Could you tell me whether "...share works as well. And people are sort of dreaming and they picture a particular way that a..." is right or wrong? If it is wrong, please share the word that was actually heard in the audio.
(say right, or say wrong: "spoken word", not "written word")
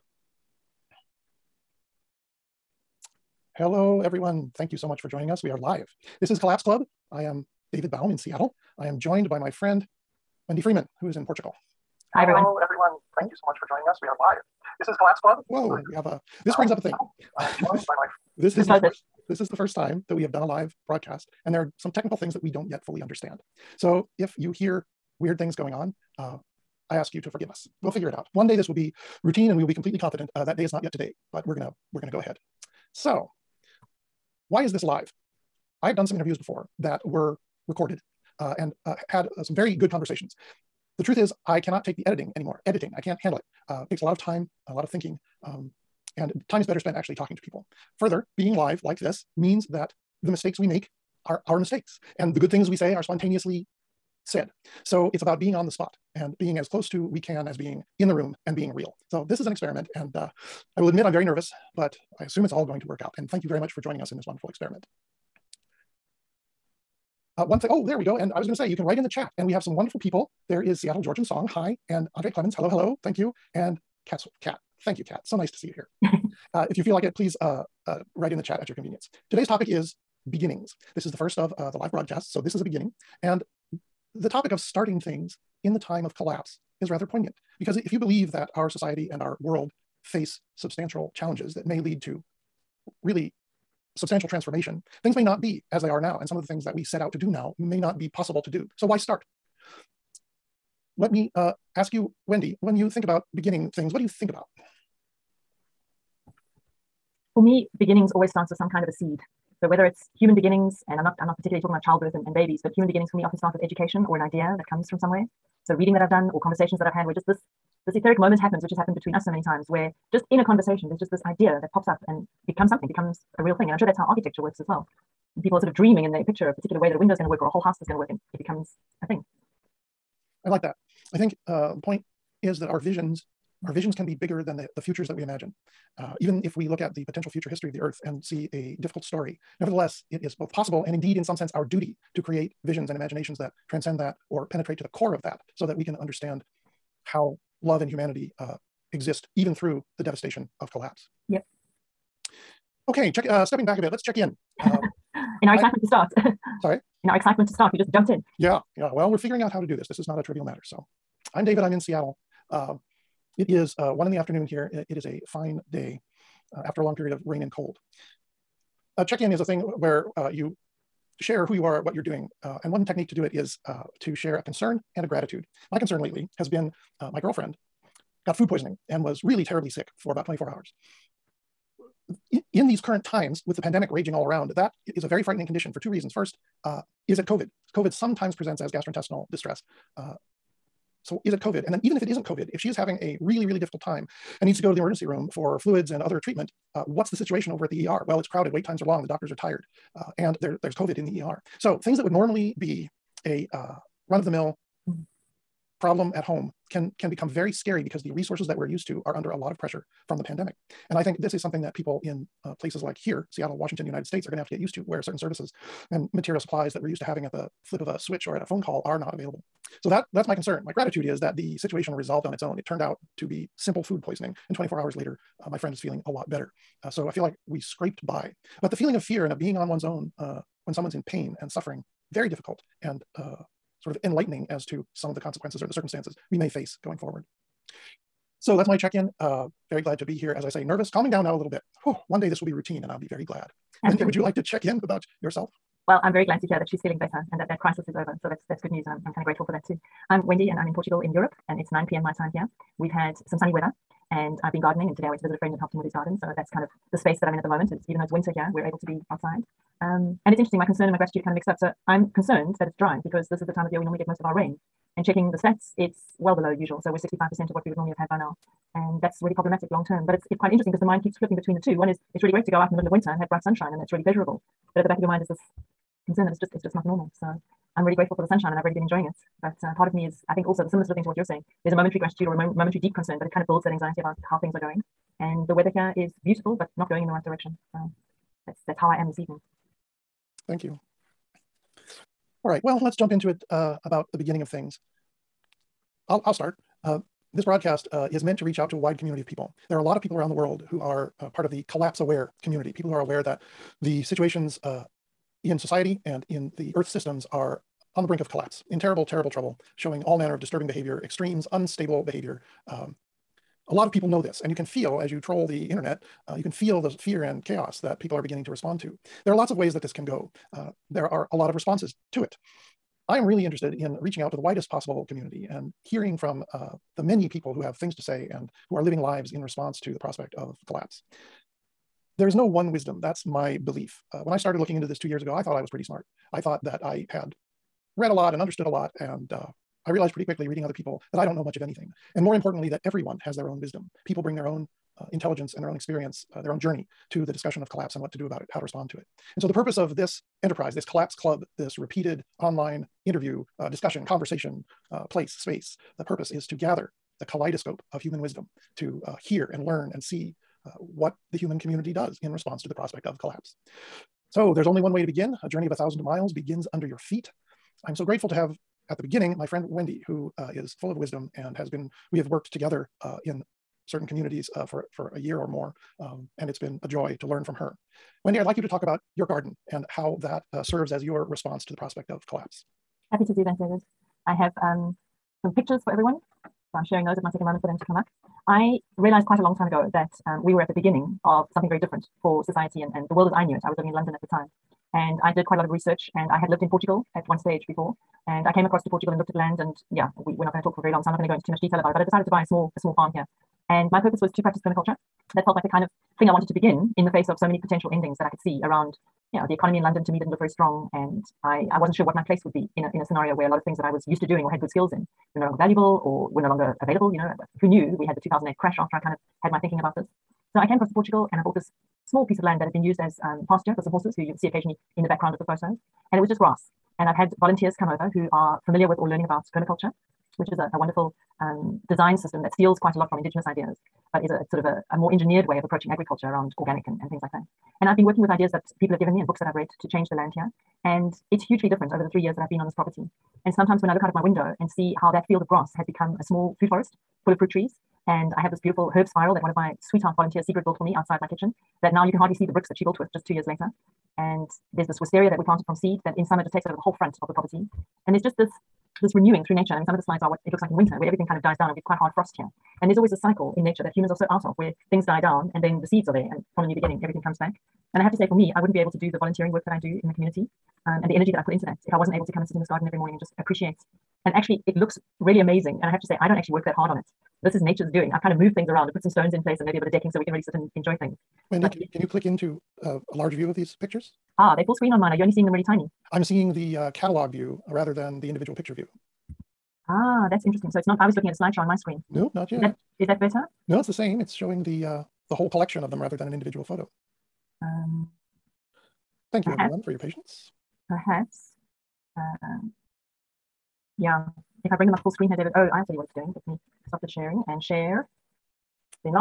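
wrong: "architecture", not "share".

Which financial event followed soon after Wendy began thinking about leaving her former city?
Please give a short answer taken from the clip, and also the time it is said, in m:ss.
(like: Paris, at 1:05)
2008 crash, at 6:58.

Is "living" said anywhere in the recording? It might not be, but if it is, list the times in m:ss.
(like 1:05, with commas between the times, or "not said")
5:28, 6:33.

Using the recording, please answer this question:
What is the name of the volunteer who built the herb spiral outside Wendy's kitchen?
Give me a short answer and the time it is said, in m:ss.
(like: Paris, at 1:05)
Secret, at 7:30.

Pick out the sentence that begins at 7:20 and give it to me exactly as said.
And it's hugely different over the three years that I've been on this property.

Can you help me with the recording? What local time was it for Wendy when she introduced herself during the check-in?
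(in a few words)
9 p.m.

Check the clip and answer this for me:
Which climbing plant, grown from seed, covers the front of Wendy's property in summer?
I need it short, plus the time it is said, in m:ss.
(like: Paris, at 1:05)
Wisteria, at 7:34.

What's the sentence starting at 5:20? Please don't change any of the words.
Uh, there are a lot of responses to it.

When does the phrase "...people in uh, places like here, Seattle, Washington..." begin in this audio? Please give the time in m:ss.
3:31.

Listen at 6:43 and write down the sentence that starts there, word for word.
And my purpose was to practice permaculture.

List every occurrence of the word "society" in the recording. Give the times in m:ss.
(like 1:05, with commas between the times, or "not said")
1:28, 5:05, 6:32.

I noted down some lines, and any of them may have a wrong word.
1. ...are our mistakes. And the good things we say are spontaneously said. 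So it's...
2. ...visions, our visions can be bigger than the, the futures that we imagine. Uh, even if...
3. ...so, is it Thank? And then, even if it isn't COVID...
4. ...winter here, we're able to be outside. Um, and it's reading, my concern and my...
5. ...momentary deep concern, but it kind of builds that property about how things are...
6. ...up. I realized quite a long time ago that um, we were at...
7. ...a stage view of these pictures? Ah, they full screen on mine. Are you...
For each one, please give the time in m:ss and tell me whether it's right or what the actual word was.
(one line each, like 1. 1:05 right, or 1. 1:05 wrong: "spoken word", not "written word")
1. 0:51 right
2. 2:12 right
3. 3:11 wrong: "COVID", not "Thank"
4. 4:18 wrong: "interesting", not "reading"
5. 4:42 wrong: "anxiety", not "property"
6. 6:27 right
7. 8:03 wrong: "large", not "stage".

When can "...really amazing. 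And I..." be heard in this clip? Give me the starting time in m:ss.
7:55.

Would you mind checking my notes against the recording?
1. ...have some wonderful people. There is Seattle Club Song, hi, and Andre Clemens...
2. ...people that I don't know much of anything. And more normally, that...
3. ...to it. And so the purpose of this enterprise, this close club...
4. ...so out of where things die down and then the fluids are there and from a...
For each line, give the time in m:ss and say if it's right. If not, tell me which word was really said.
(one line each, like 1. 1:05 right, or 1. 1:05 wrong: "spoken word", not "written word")
1. 1:09 wrong: "Georgian", not "Club"
2. 5:40 wrong: "importantly", not "normally"
3. 5:48 wrong: "collapse", not "close"
4. 7:44 wrong: "seeds", not "fluids".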